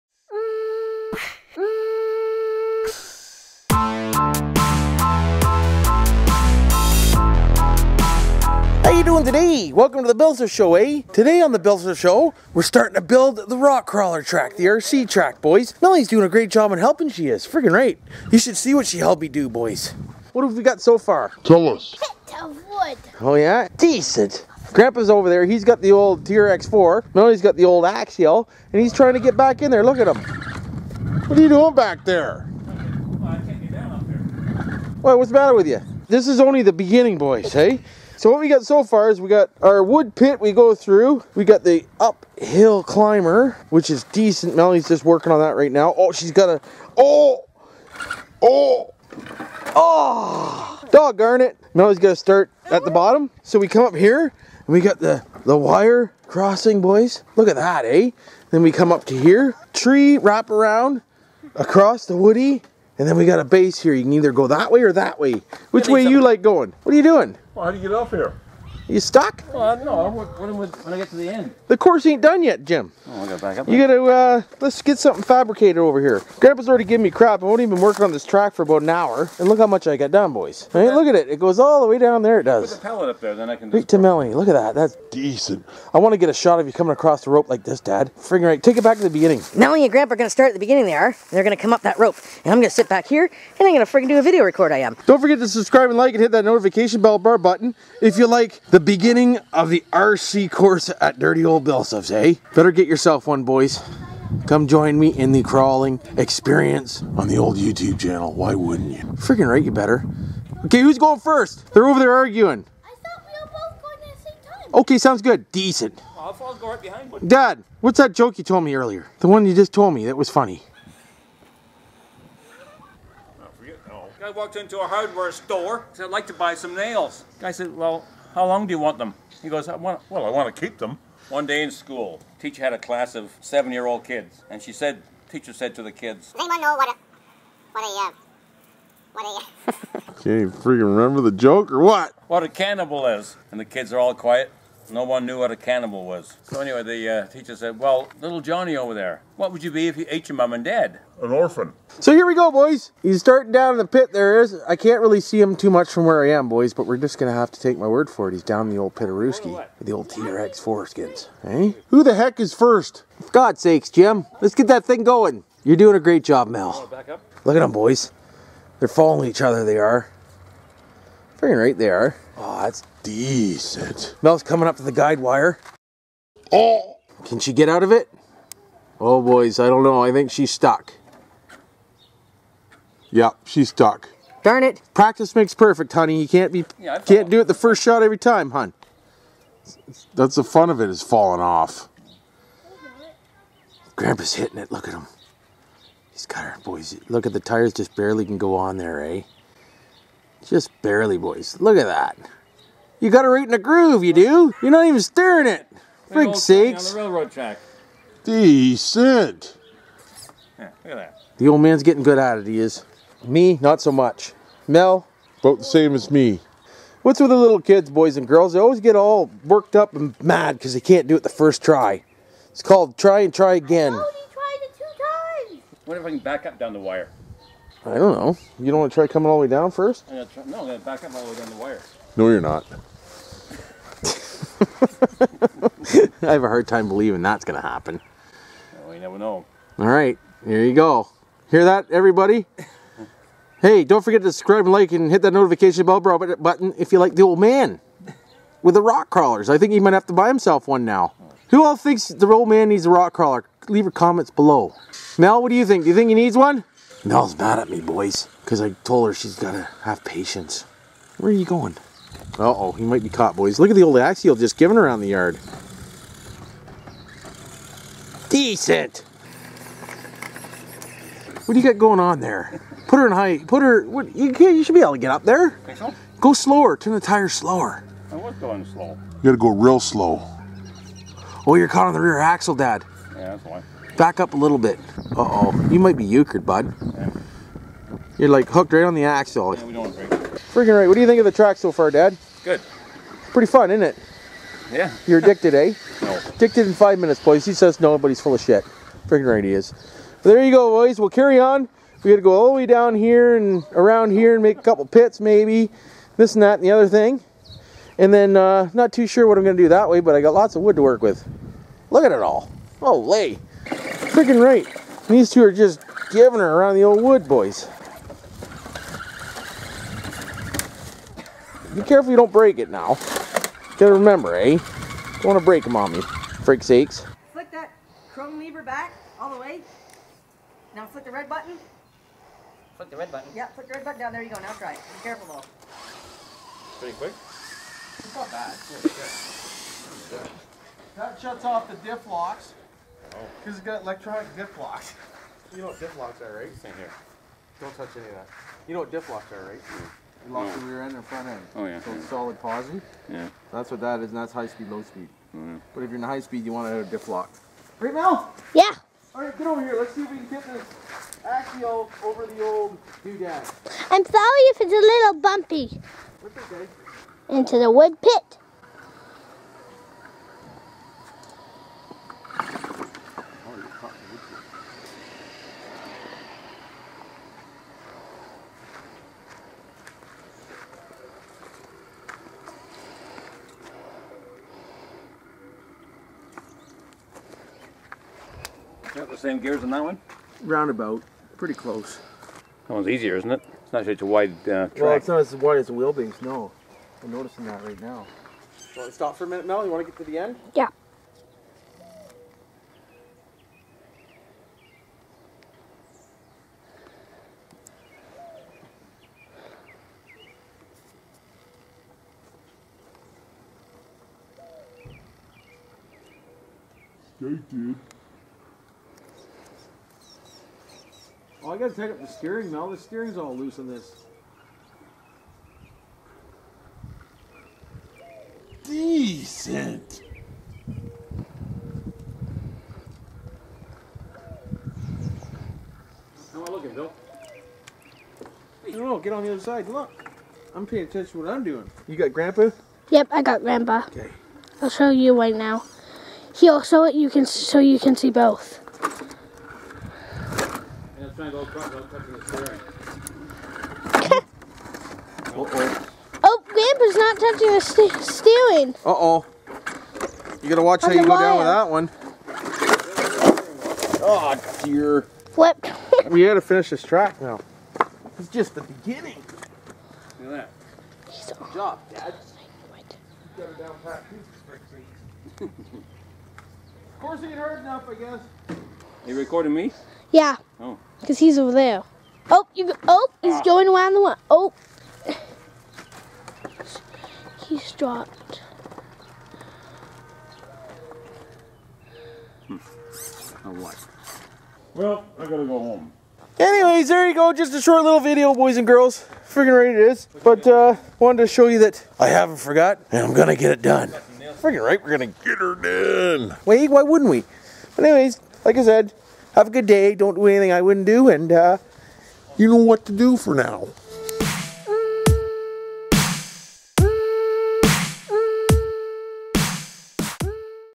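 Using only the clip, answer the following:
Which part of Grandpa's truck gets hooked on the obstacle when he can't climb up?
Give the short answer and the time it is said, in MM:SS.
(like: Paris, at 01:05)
Rear axle, at 04:41.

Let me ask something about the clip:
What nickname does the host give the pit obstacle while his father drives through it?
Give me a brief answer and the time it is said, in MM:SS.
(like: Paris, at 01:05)
Pitarooski, at 02:38.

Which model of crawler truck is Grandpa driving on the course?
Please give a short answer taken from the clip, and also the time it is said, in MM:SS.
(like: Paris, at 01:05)
TRX4, at 00:26.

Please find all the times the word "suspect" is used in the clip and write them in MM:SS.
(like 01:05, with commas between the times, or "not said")
not said.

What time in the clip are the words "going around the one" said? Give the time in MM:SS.
08:03.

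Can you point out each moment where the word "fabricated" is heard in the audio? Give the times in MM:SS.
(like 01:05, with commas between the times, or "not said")
01:15.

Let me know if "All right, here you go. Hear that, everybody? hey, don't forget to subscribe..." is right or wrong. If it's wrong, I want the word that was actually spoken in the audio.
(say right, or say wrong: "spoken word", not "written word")
right.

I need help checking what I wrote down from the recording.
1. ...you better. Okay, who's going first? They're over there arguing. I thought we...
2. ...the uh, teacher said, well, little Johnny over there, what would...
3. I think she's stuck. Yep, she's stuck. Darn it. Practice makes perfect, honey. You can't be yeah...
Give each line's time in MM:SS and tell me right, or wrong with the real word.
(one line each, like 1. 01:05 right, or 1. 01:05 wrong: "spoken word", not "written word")
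1. 01:49 right
2. 02:26 right
3. 03:00 right.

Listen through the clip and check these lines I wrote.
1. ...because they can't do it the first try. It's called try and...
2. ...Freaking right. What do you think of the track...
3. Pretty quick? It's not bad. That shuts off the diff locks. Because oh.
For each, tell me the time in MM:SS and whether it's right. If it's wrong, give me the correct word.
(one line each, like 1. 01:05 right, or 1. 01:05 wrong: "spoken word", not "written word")
1. 03:40 right
2. 04:50 right
3. 05:36 right.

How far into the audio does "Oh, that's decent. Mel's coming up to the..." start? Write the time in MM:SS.
02:52.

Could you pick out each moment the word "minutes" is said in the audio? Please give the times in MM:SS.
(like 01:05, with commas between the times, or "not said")
04:56, 06:39.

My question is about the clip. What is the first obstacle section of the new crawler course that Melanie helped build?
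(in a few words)
Pit of wood.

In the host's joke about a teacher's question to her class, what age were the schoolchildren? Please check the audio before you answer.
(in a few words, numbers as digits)
7.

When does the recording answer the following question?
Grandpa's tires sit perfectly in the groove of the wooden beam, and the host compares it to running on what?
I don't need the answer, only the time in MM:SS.
03:27.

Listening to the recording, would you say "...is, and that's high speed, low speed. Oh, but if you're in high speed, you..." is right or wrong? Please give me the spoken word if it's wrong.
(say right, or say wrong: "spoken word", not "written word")
right.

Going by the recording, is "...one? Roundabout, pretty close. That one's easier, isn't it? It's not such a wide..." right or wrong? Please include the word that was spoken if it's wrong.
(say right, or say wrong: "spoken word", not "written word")
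right.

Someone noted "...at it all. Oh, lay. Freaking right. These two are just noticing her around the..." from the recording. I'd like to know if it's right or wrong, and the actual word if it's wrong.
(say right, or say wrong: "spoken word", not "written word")
wrong: "giving", not "noticing".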